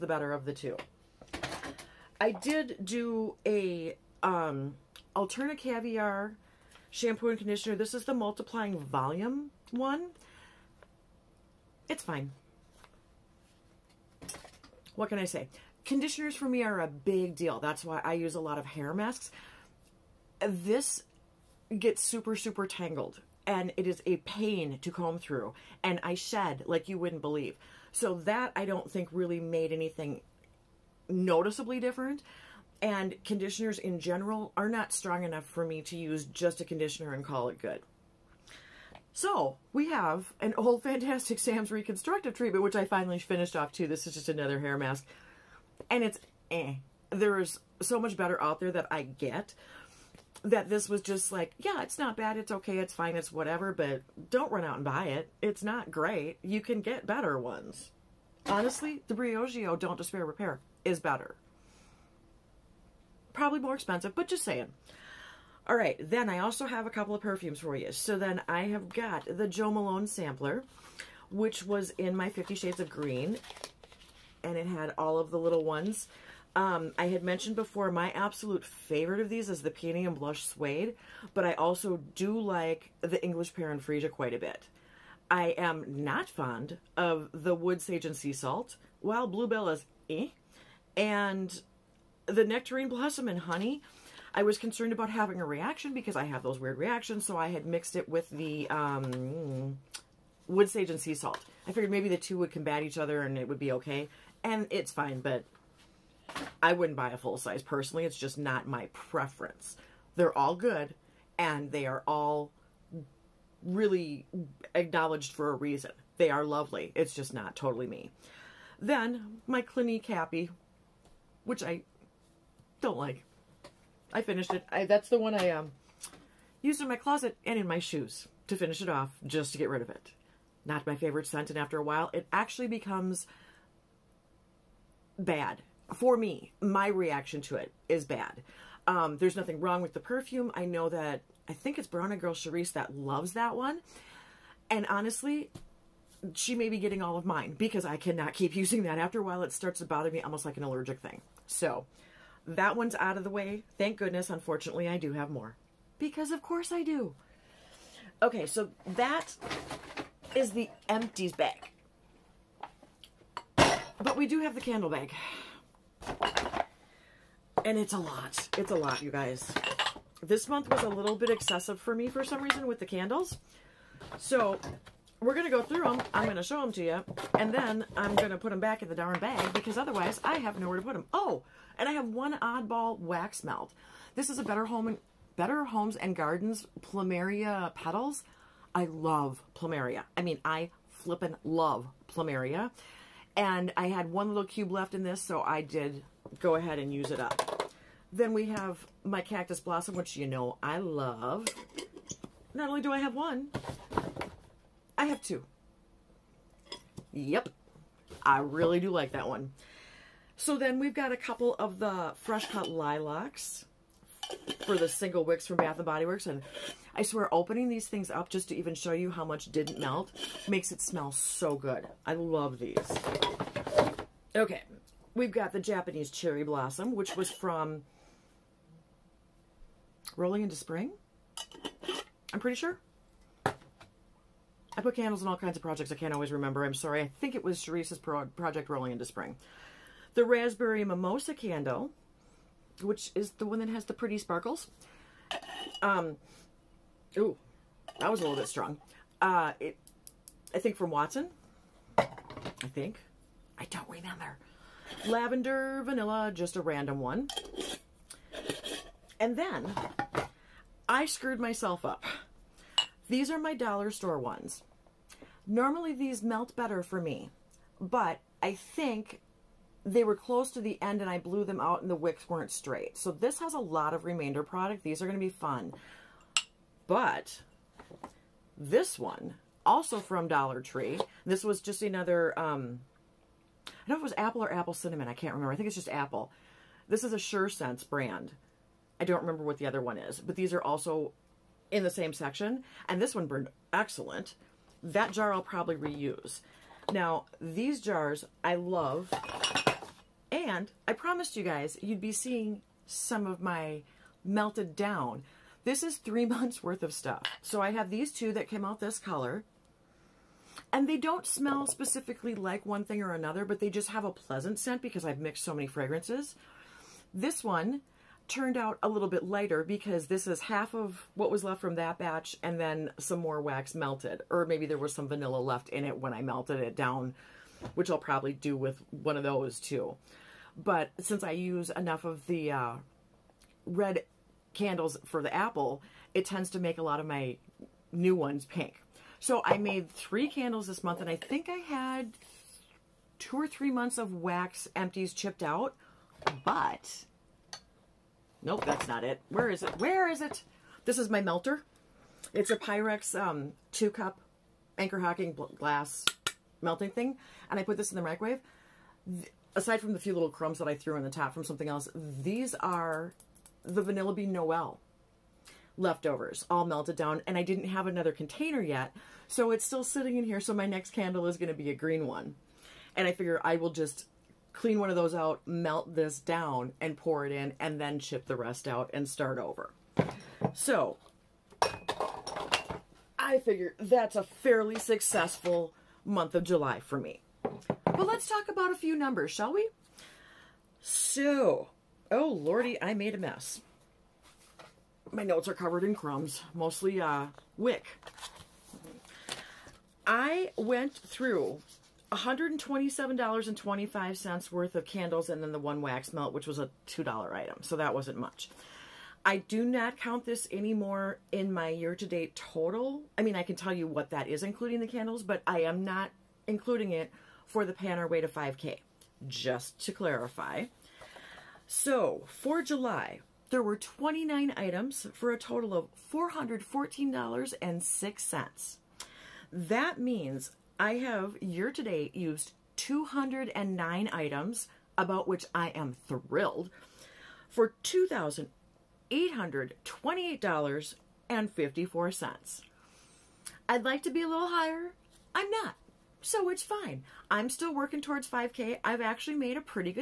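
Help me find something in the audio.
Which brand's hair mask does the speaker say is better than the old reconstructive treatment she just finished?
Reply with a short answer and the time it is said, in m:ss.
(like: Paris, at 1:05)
Briogeo, at 0:59.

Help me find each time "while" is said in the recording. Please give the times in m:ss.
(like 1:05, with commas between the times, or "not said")
1:28, 2:11, 2:29.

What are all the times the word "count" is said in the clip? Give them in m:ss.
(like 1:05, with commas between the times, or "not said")
6:49.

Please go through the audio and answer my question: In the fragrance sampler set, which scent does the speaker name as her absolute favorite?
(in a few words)
Peony and Blush Suede.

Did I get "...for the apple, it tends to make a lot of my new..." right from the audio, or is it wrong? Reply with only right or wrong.
right.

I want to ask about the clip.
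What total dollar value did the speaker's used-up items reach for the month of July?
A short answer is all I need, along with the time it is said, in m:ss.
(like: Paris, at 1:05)
$414.06, at 7:06.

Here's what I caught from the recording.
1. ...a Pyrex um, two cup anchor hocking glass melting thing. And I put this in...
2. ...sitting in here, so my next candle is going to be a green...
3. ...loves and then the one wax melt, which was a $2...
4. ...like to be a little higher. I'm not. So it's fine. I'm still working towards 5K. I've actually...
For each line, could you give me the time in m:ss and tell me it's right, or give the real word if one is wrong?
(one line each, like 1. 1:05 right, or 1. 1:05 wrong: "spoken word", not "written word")
1. 5:52 right
2. 6:09 right
3. 6:44 wrong: "candles", not "loves"
4. 7:23 right.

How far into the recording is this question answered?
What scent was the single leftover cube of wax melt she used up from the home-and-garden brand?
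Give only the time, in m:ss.
3:06.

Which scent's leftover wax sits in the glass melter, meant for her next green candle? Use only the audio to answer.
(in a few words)
Vanilla Bean Noel.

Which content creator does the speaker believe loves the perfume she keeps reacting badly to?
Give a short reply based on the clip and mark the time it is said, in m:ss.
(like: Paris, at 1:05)
Brown Girl Charisse, at 2:21.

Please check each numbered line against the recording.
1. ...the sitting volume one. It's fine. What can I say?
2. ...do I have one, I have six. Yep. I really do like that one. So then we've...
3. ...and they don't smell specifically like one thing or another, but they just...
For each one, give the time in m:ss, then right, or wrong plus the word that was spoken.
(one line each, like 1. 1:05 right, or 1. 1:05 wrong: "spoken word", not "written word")
1. 0:08 wrong: "multiplying", not "sitting"
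2. 3:22 wrong: "two", not "six"
3. 5:10 right.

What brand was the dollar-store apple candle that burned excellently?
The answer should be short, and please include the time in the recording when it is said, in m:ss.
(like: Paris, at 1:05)
Sure Sense, at 4:47.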